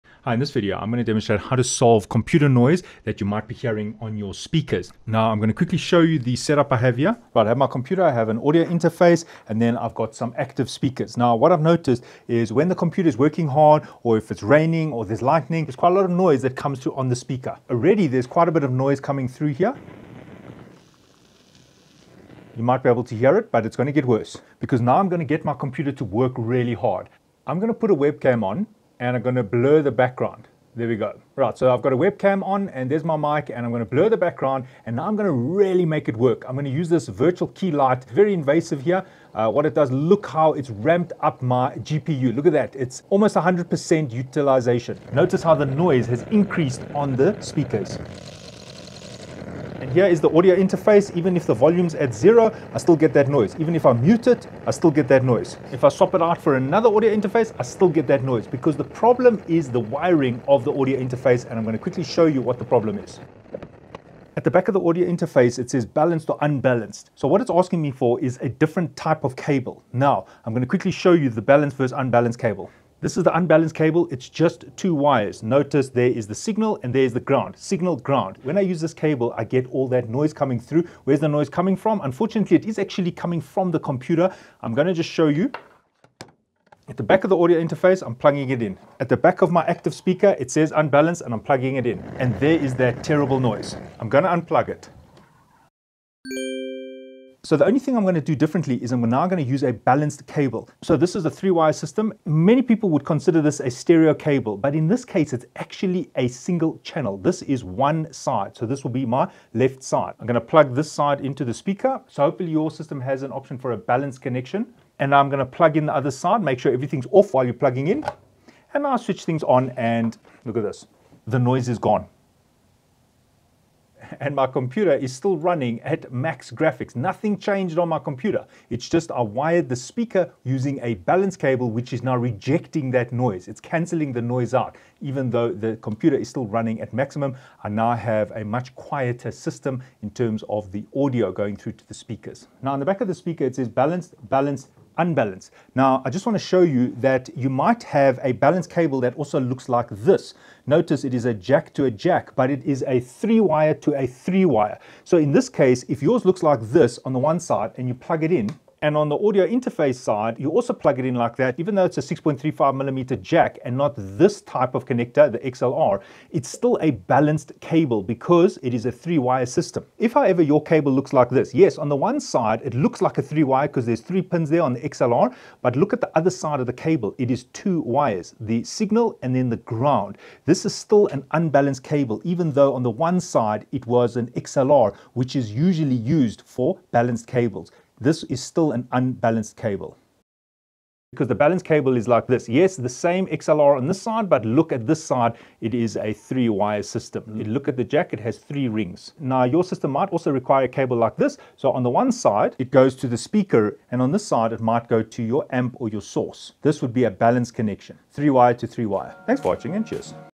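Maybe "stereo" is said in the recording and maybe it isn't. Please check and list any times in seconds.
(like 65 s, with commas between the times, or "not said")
103 s.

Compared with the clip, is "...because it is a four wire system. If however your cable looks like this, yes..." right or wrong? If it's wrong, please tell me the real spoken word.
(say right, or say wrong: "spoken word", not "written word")
wrong: "three", not "four".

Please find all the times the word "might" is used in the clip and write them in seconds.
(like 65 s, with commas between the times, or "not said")
3 s, 22 s, 147 s, 199 s, 204 s.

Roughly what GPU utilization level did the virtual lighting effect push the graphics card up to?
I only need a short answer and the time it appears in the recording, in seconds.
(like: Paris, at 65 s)
almost 100%, at 43 s.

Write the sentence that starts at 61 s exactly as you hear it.
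And I'm gonna quickly show you what the problem is.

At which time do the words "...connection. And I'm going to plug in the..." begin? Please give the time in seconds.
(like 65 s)
114 s.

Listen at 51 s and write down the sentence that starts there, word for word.
Even if the volume's at zero, I still get that noise.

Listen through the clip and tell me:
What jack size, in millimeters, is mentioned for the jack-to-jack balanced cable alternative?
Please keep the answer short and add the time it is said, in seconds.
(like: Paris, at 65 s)
6.35 millimeter, at 162 s.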